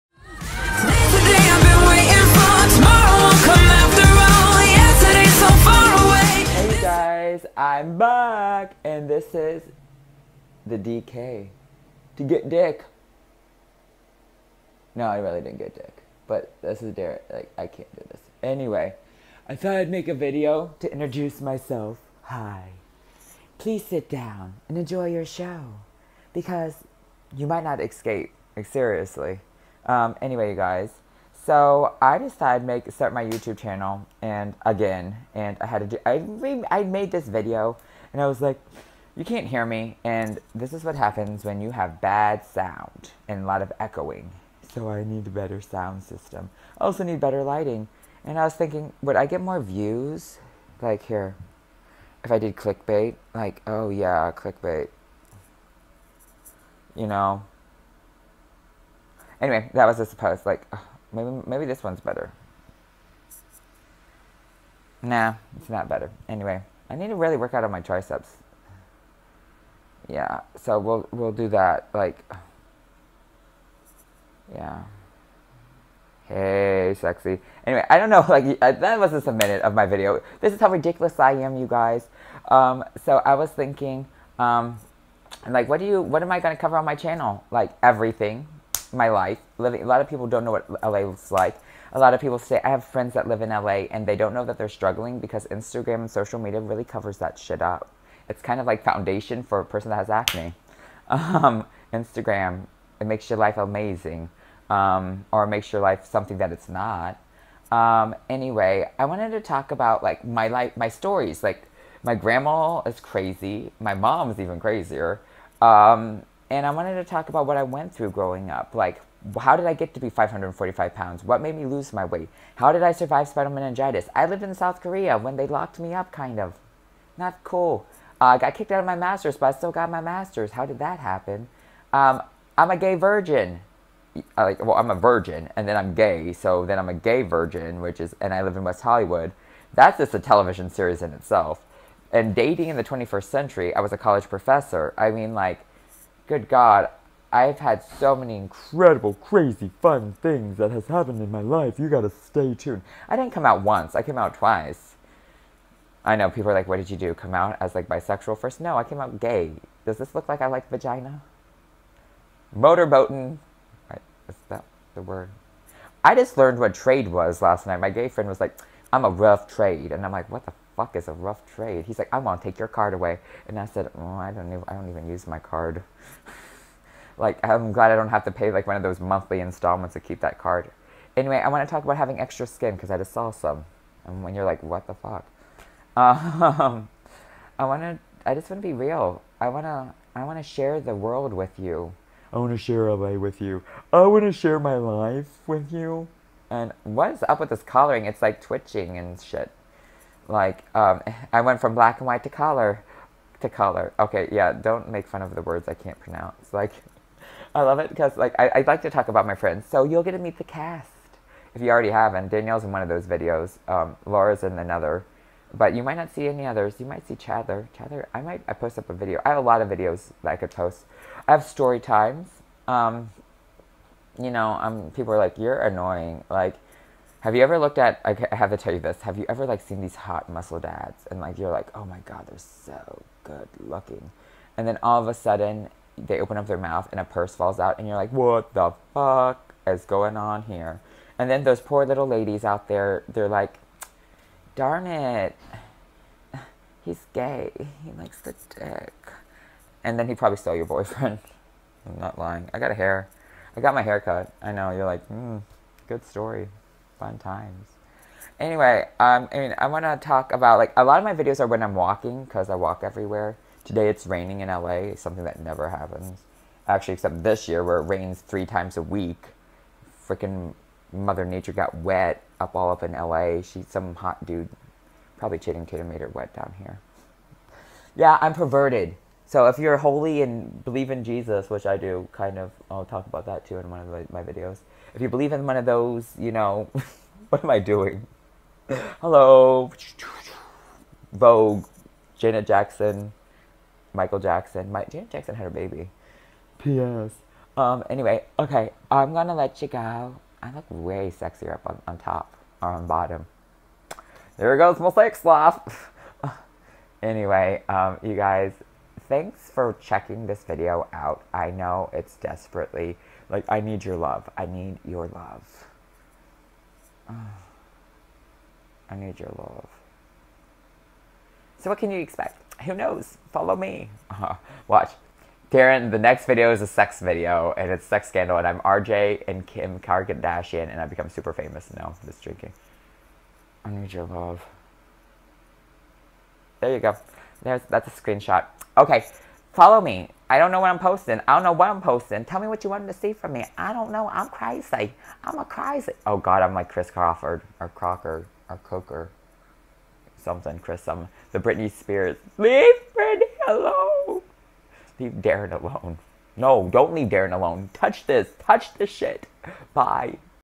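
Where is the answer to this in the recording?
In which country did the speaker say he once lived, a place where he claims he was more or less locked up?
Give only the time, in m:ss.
2:04.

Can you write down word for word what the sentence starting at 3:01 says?
Anyway, I want to talk about having extra skin because I just saw some.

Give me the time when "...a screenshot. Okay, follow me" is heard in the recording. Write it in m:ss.
5:37.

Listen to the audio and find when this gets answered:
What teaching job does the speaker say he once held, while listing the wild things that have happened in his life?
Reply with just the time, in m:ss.
2:23.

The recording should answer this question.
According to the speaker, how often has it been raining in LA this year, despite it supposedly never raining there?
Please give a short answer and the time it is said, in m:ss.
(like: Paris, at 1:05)
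3 times a week, at 4:28.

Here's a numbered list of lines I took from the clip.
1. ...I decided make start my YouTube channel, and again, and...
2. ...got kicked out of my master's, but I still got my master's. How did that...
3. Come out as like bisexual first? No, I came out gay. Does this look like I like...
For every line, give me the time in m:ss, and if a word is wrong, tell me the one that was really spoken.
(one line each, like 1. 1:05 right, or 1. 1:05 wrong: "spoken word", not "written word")
1. 0:32 right
2. 2:08 right
3. 2:37 right.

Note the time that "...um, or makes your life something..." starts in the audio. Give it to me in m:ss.
1:44.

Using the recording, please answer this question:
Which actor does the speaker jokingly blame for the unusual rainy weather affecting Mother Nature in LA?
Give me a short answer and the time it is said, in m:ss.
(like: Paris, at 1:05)
Channing Tatum, at 4:35.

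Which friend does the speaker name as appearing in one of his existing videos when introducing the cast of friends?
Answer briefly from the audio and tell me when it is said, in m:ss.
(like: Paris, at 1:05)
Danielle, at 3:32.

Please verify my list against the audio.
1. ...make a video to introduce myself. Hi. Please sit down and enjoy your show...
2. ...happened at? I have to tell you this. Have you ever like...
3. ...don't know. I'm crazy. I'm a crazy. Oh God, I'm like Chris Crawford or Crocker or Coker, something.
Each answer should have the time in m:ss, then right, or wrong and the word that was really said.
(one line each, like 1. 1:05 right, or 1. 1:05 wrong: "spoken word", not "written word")
1. 0:19 right
2. 3:47 wrong: "looked", not "happened"
3. 5:43 right.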